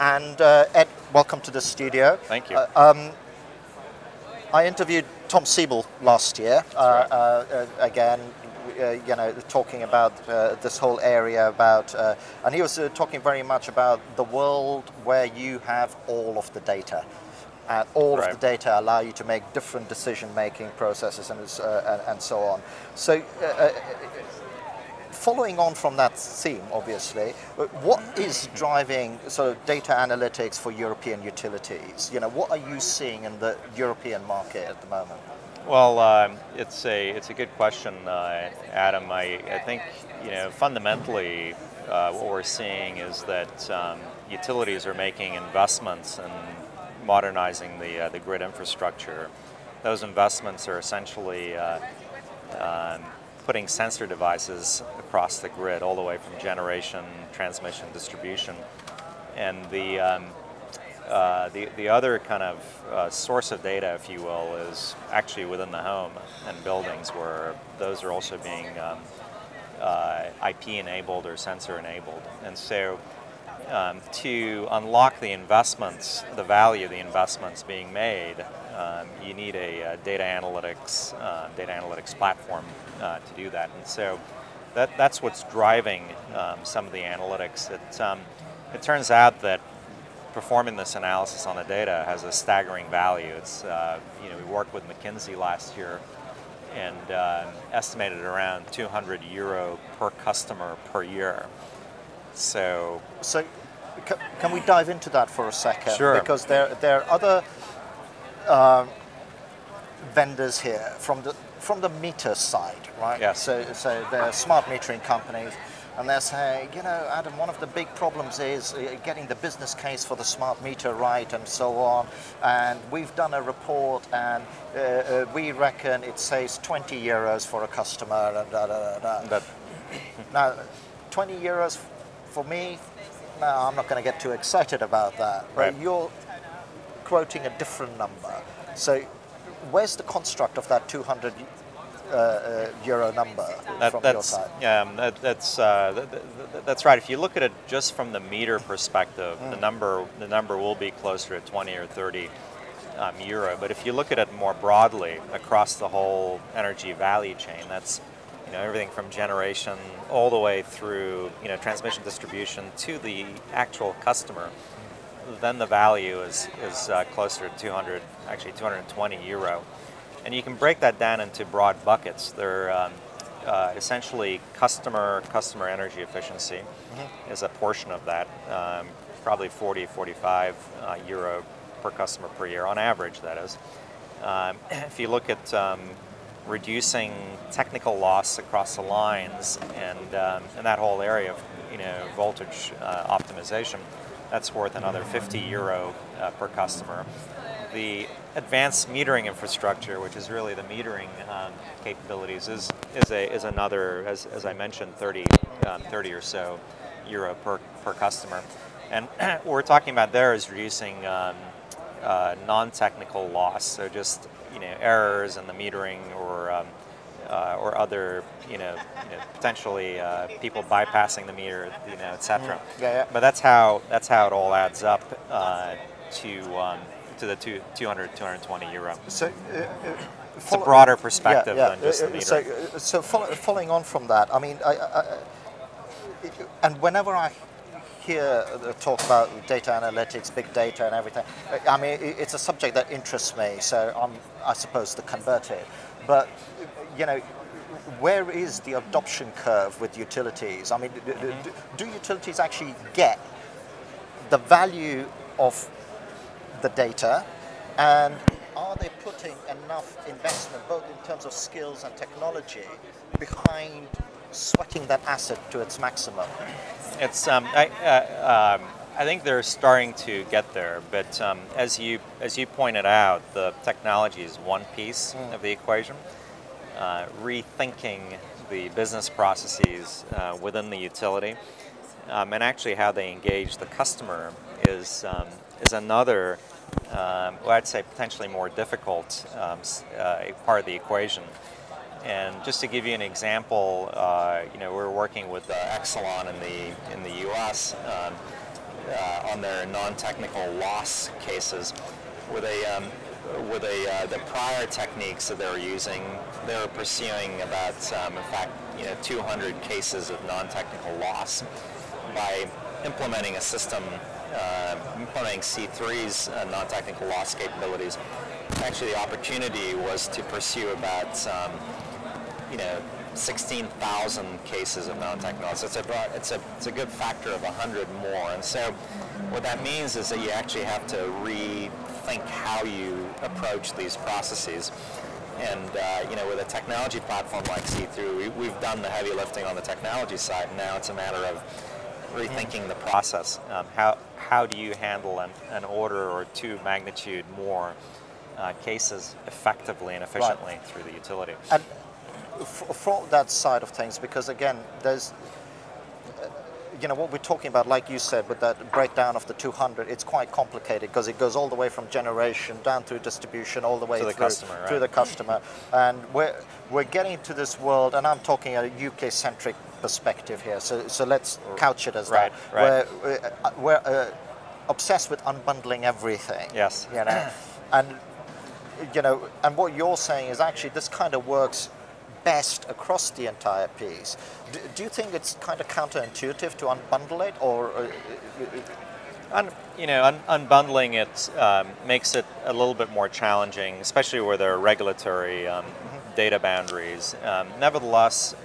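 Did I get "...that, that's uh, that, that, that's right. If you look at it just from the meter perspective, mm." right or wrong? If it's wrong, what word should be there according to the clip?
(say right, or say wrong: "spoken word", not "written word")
right.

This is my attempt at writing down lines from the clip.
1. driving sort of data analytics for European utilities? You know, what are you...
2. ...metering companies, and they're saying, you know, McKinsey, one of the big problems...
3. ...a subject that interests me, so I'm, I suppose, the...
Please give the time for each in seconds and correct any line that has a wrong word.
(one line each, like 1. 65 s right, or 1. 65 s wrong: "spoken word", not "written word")
1. 28 s right
2. 114 s wrong: "Adam", not "McKinsey"
3. 242 s right.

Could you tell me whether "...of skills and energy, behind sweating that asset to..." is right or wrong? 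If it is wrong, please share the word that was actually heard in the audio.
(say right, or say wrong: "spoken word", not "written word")
wrong: "technology", not "energy".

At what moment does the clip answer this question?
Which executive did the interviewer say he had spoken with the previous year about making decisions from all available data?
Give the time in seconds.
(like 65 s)
5 s.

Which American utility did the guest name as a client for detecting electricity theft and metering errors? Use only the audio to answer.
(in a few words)
Exelon.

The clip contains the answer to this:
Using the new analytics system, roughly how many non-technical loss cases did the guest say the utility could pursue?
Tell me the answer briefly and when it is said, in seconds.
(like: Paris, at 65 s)
16,000, at 323 s.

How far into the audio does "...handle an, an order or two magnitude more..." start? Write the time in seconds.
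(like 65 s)
344 s.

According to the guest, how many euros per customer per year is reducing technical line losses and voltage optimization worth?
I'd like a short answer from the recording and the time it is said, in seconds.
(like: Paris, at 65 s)
50 euro, at 195 s.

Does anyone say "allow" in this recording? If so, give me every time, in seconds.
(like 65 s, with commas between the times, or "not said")
18 s.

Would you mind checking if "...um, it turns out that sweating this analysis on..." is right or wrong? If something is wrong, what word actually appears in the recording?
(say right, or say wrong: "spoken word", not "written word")
wrong: "performing", not "sweating".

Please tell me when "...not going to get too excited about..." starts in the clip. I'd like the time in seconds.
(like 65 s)
133 s.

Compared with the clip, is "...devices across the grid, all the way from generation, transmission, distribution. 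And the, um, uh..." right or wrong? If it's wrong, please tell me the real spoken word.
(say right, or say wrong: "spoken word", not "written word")
right.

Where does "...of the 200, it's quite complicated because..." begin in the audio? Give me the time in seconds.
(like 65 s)
359 s.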